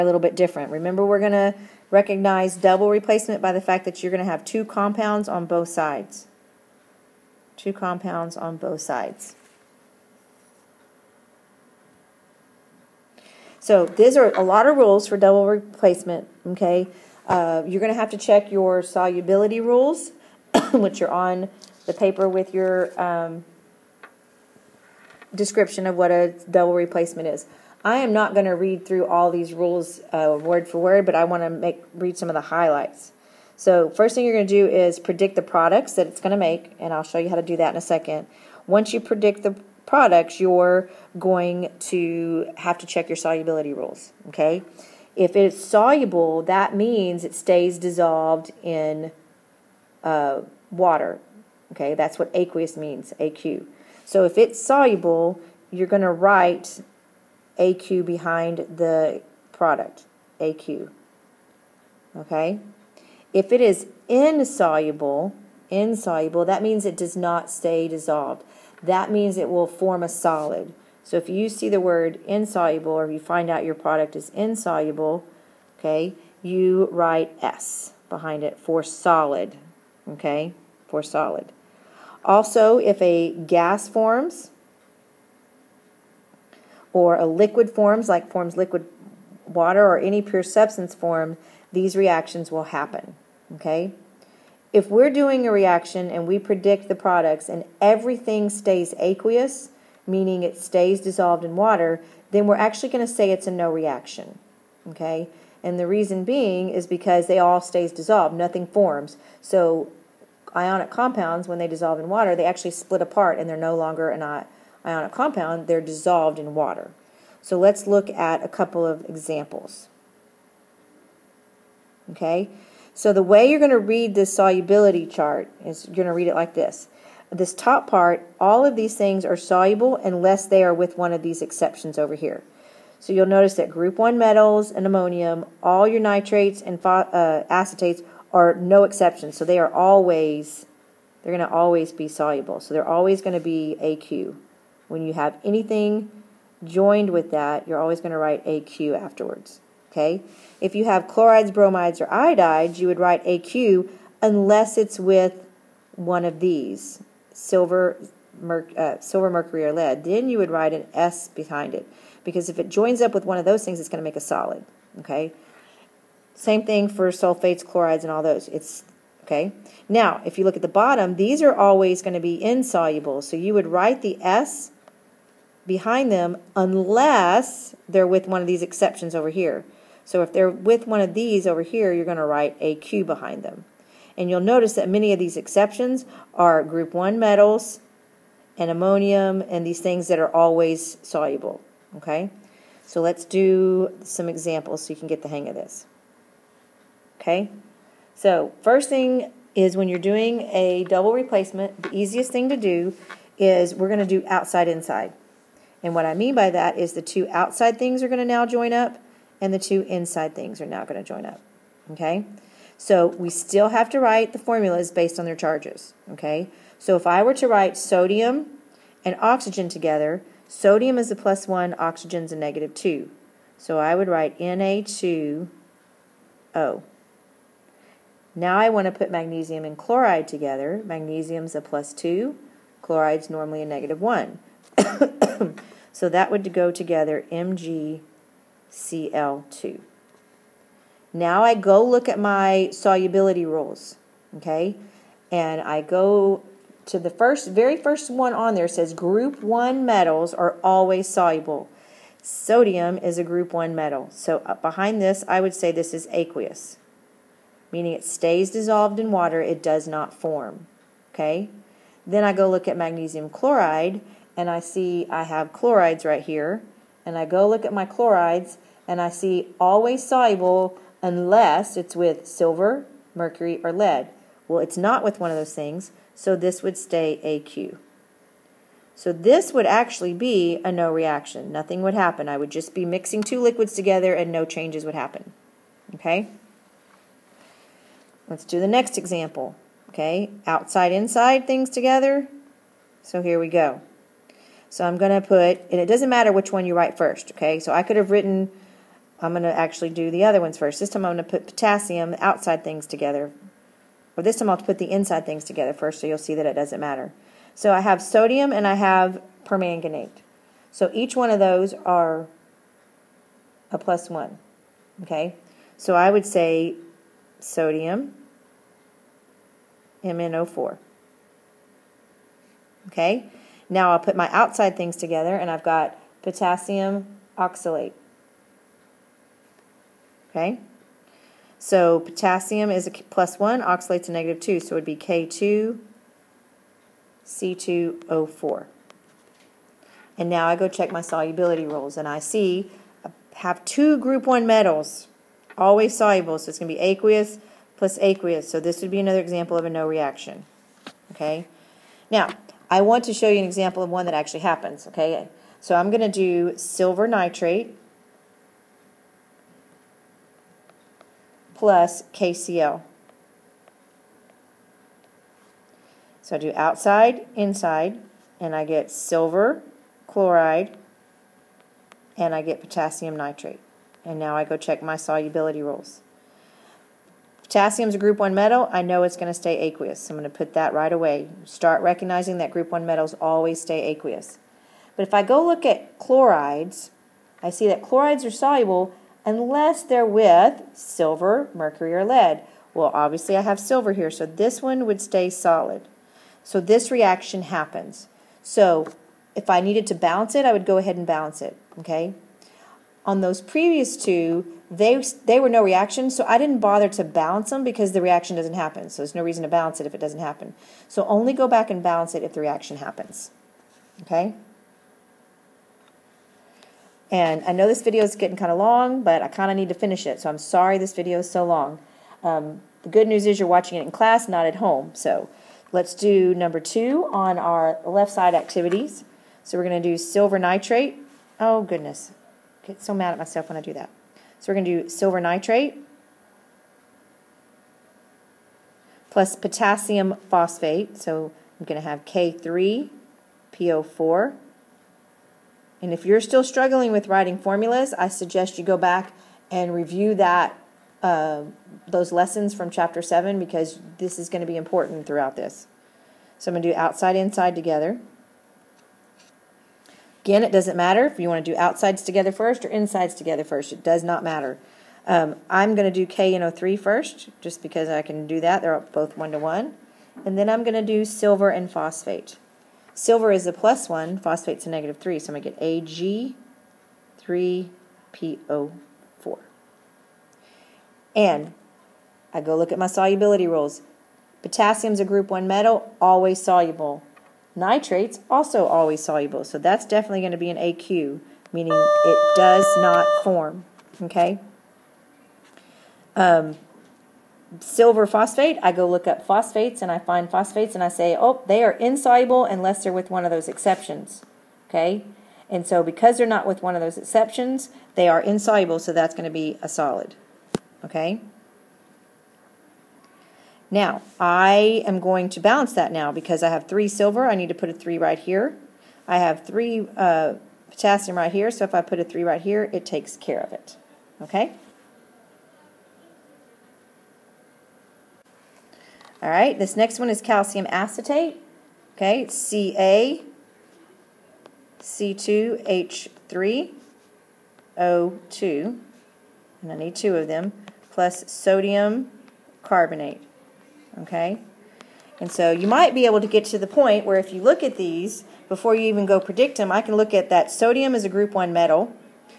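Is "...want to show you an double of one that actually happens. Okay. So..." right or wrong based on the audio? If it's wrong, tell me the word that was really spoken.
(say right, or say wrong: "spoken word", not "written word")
wrong: "example", not "double".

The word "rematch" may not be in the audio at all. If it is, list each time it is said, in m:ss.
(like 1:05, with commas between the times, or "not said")
not said.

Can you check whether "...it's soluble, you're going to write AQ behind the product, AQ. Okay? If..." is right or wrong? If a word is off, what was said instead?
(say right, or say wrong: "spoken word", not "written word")
right.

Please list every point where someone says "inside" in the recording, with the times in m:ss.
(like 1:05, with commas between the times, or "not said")
3:24, 3:29, 4:50, 5:04, 6:07, 7:37, 7:42.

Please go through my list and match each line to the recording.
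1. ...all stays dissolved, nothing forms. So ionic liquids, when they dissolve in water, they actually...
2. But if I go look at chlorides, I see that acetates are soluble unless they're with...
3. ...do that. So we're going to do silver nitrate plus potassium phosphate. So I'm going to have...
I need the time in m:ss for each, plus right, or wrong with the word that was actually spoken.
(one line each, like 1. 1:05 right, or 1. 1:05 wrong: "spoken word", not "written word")
1. 1:47 wrong: "compounds", not "liquids"
2. 6:24 wrong: "chlorides", not "acetates"
3. 7:13 right.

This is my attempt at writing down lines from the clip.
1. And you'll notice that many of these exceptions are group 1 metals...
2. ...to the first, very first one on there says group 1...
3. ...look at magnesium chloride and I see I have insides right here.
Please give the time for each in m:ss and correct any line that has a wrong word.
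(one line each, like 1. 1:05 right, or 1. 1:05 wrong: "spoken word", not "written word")
1. 3:04 right
2. 4:06 right
3. 4:22 wrong: "chlorides", not "insides".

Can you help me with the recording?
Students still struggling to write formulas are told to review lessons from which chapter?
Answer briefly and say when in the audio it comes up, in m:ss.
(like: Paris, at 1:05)
Chapter 7, at 7:32.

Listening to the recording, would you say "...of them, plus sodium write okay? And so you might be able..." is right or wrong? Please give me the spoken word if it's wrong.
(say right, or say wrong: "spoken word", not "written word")
wrong: "carbonate", not "write".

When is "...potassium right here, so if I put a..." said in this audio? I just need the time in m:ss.
8:40.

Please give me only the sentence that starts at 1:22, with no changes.
Also, if a gas forms or a liquid forms, like forms liquid water or any pure substance form, these reactions will happen.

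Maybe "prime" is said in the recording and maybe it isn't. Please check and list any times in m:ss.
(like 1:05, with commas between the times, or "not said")
not said.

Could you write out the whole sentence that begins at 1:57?
So let's look at a couple of examples.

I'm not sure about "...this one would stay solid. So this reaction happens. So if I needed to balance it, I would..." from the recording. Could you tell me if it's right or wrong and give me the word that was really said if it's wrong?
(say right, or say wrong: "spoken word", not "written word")
right.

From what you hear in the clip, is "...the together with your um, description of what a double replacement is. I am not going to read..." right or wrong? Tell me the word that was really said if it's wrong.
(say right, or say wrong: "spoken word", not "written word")
wrong: "paper", not "together".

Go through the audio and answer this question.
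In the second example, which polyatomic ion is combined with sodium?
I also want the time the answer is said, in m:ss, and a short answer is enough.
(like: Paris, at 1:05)
Permanganate, at 5:09.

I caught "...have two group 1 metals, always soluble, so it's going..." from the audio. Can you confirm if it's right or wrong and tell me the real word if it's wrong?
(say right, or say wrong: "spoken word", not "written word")
right.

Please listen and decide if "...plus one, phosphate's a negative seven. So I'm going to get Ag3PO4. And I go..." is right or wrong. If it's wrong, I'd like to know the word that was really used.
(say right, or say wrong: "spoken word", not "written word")
wrong: "three", not "seven".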